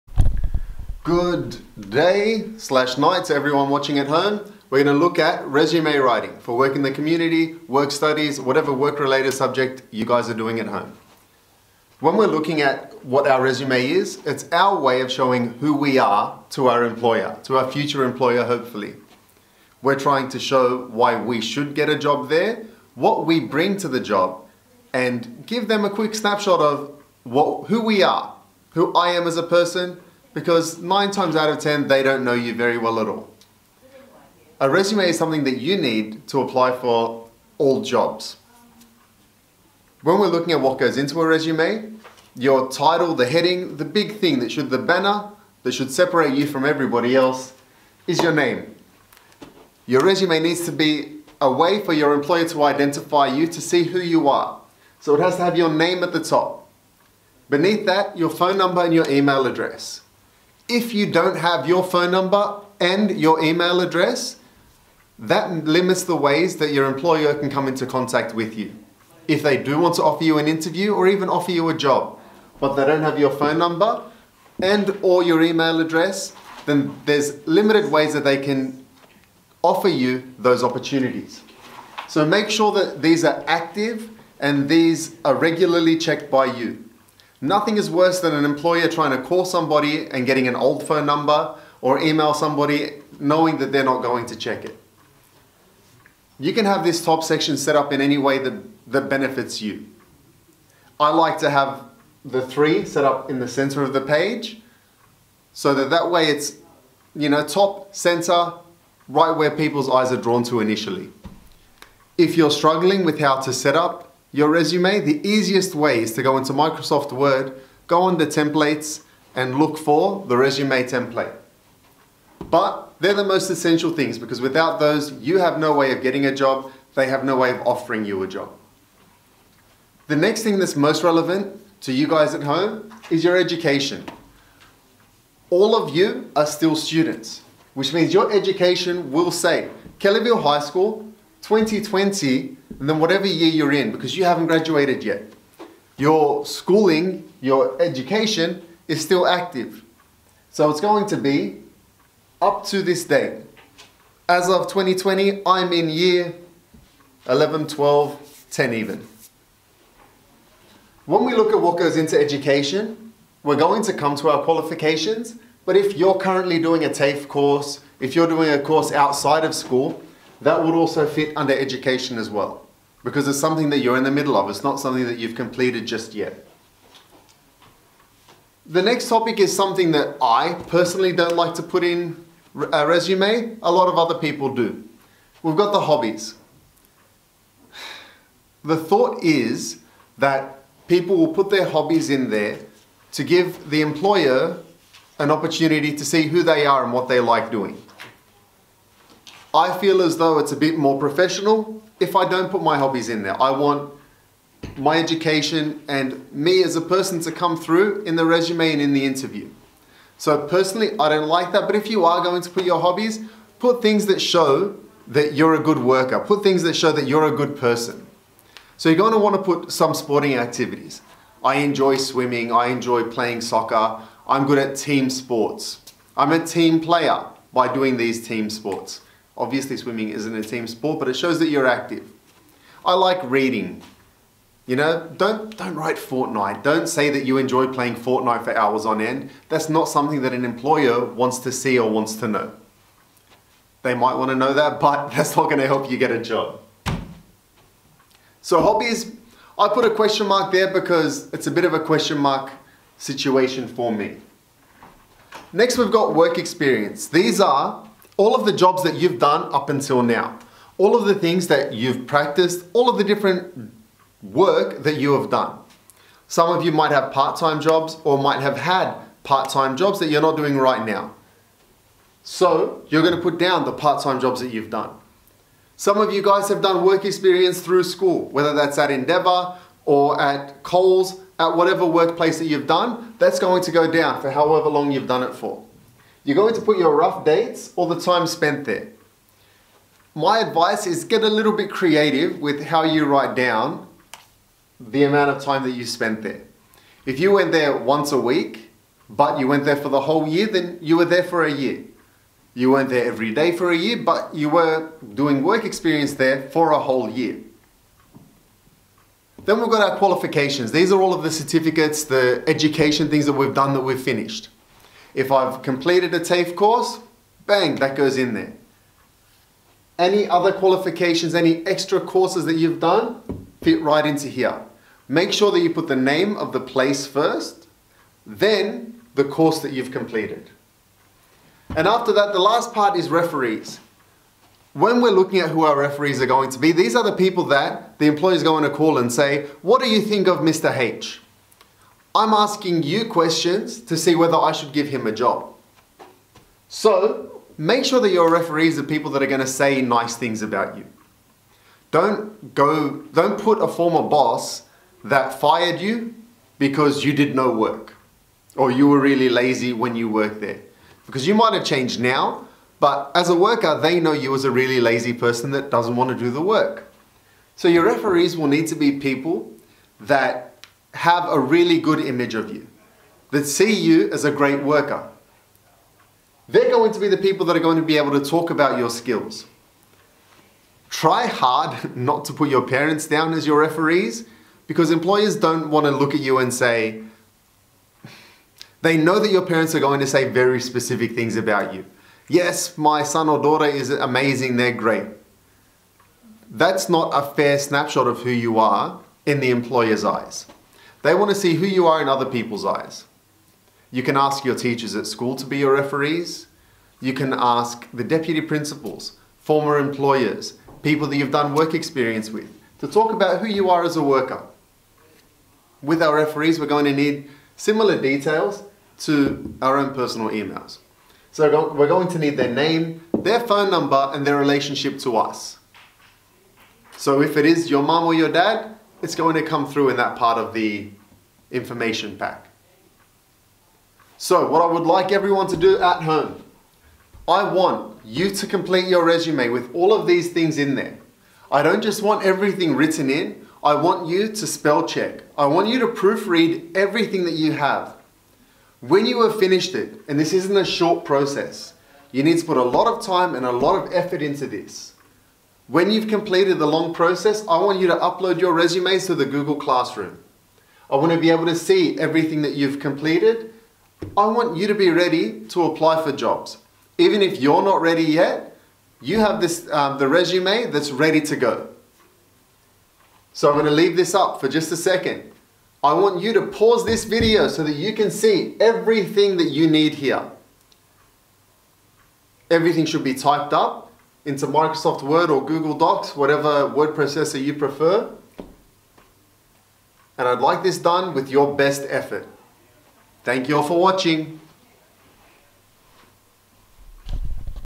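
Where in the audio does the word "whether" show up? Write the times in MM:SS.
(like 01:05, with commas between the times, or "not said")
04:38, 05:44.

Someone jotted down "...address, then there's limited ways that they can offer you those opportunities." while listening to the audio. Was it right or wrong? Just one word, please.
right.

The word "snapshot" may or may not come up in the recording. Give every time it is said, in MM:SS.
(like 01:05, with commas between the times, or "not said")
00:26, 06:37.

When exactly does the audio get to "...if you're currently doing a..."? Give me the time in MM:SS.
02:45.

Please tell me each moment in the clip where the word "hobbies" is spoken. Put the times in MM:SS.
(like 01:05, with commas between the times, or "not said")
03:05, 03:11, 03:22, 03:32, 04:08.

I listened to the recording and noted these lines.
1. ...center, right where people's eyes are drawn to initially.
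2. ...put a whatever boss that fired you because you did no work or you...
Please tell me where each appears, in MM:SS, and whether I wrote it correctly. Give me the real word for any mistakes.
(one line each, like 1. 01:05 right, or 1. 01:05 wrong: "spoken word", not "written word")
1. 01:47 right
2. 05:53 wrong: "former", not "whatever".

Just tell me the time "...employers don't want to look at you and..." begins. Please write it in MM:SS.
06:24.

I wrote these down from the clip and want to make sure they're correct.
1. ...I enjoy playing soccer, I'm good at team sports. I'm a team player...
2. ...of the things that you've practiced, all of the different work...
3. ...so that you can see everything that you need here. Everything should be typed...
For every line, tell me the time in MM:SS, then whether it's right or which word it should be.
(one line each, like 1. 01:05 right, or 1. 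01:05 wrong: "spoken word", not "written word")
1. 03:42 right
2. 04:20 right
3. 07:57 right.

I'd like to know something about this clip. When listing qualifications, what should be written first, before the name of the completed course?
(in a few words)
the name of the place.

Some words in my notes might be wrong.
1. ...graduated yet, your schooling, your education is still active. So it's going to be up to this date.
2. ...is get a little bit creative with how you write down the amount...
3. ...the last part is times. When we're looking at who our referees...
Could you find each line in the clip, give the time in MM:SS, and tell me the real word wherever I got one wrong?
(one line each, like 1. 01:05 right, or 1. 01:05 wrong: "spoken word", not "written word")
1. 02:24 right
2. 04:50 right
3. 05:32 wrong: "referees", not "times".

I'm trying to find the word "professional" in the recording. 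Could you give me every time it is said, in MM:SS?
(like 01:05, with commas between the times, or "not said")
03:20.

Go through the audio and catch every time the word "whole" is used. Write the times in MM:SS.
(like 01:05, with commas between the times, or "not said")
05:00, 05:06.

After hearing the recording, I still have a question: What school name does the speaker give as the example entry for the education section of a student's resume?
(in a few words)
Kellyville High School.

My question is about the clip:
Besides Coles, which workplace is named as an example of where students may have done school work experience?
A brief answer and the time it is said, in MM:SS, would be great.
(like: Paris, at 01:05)
Endeavour, at 04:38.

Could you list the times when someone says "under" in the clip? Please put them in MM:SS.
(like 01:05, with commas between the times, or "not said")
01:58, 02:51.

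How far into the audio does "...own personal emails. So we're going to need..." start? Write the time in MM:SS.
06:59.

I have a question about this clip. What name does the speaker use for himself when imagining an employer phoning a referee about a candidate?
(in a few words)
Mr. H.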